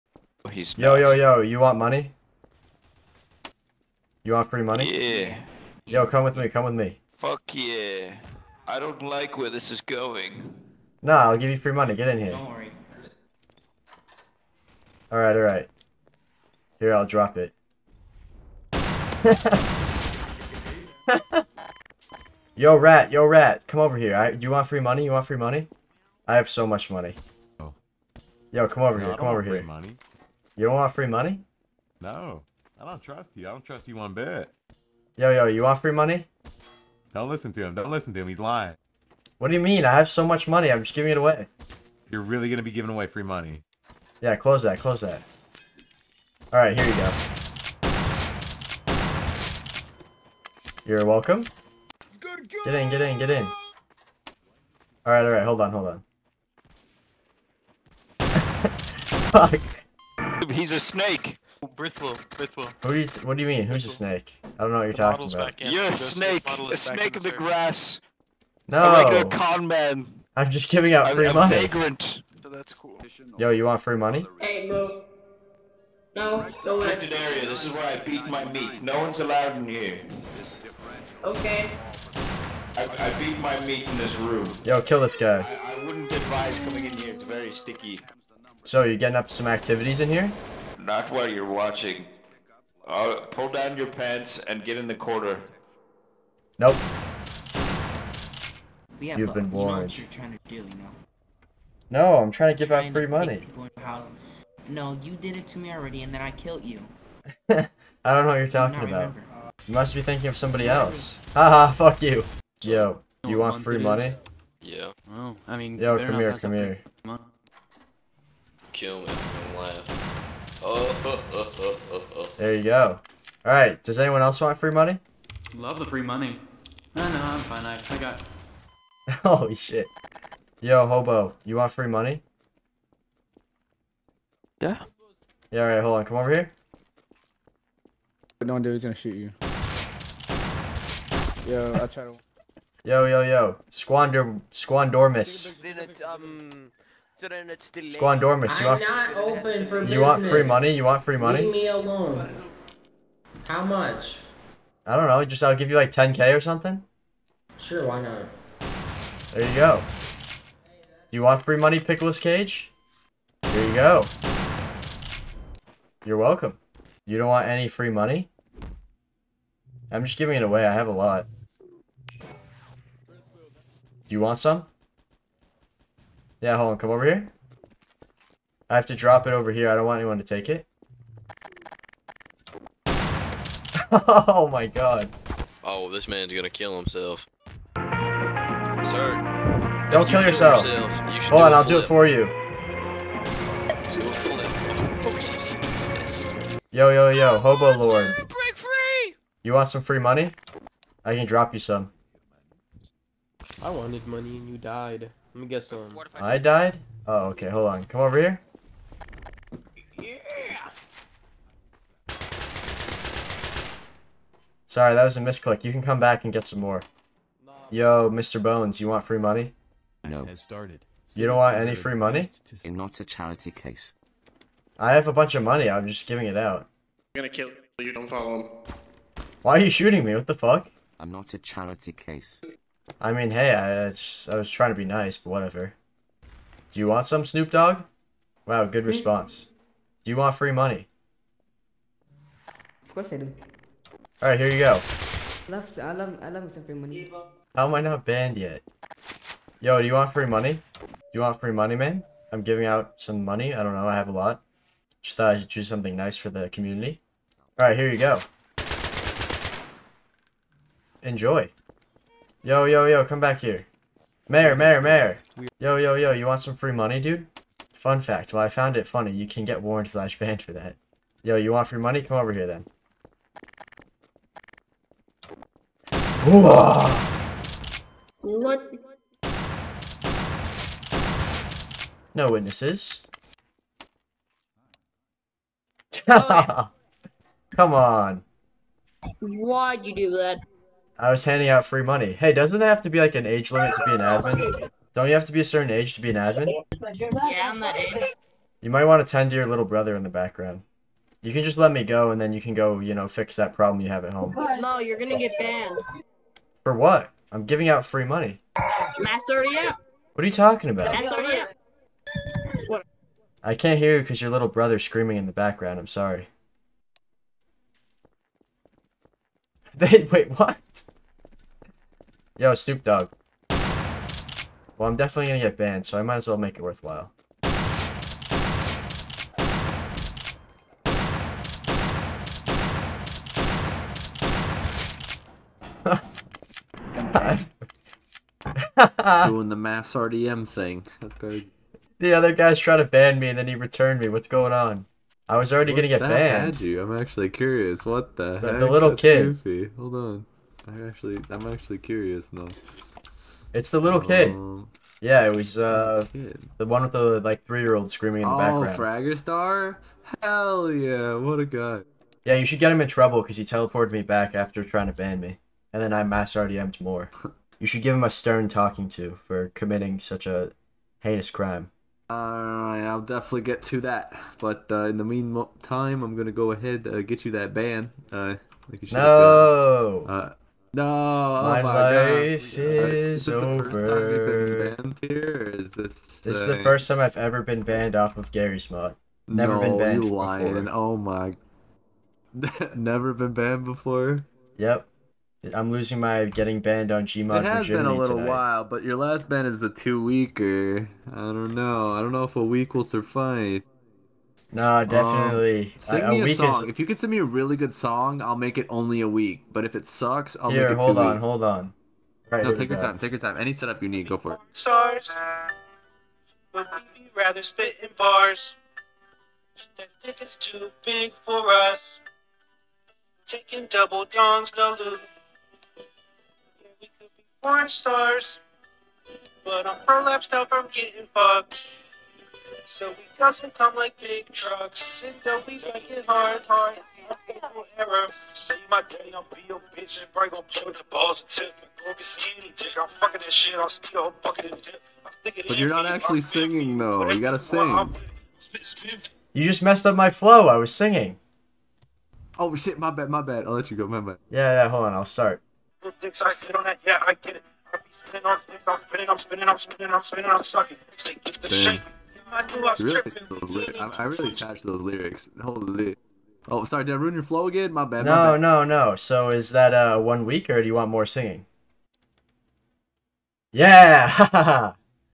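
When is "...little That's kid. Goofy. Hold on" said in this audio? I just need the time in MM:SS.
05:48.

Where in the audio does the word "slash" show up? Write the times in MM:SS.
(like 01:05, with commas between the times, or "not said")
04:29.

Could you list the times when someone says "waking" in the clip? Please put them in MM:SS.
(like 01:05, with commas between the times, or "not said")
not said.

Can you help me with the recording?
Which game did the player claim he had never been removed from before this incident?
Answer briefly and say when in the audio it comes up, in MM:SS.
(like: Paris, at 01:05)
Garry's mod, at 06:28.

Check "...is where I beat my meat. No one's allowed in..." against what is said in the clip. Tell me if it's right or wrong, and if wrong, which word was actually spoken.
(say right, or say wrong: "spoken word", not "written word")
right.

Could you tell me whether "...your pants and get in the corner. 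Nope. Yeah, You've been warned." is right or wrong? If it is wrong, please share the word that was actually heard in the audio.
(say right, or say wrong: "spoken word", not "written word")
right.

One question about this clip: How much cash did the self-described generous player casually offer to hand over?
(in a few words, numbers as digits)
10k.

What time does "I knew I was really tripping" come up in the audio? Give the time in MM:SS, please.
07:42.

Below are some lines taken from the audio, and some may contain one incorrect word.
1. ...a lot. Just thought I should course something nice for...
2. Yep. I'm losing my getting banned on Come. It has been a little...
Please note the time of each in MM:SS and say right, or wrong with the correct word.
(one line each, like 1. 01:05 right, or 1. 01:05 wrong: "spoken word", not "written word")
1. 04:14 wrong: "choose", not "course"
2. 06:34 wrong: "Gmod", not "Come".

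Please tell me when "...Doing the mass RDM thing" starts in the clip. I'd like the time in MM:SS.
05:39.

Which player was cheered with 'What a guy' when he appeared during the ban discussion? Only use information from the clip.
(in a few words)
Fragger Star.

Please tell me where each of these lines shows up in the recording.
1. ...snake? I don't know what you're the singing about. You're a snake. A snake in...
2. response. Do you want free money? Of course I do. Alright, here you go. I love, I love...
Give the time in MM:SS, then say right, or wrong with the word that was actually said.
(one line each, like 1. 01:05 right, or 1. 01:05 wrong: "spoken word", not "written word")
1. 01:03 wrong: "talking", not "singing"
2. 03:58 right.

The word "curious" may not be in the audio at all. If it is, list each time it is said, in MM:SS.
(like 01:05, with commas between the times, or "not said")
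05:47, 05:51.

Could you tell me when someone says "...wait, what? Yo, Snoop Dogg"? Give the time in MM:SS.
05:20.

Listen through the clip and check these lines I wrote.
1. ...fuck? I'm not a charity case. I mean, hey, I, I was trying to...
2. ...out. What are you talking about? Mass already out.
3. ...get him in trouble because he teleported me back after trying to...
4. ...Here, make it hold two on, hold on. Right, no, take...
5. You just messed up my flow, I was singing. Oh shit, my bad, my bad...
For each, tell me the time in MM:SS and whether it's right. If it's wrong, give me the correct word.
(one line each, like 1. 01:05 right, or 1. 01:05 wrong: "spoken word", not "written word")
1. 03:50 right
2. 05:09 right
3. 06:02 right
4. 06:50 right
5. 07:29 right.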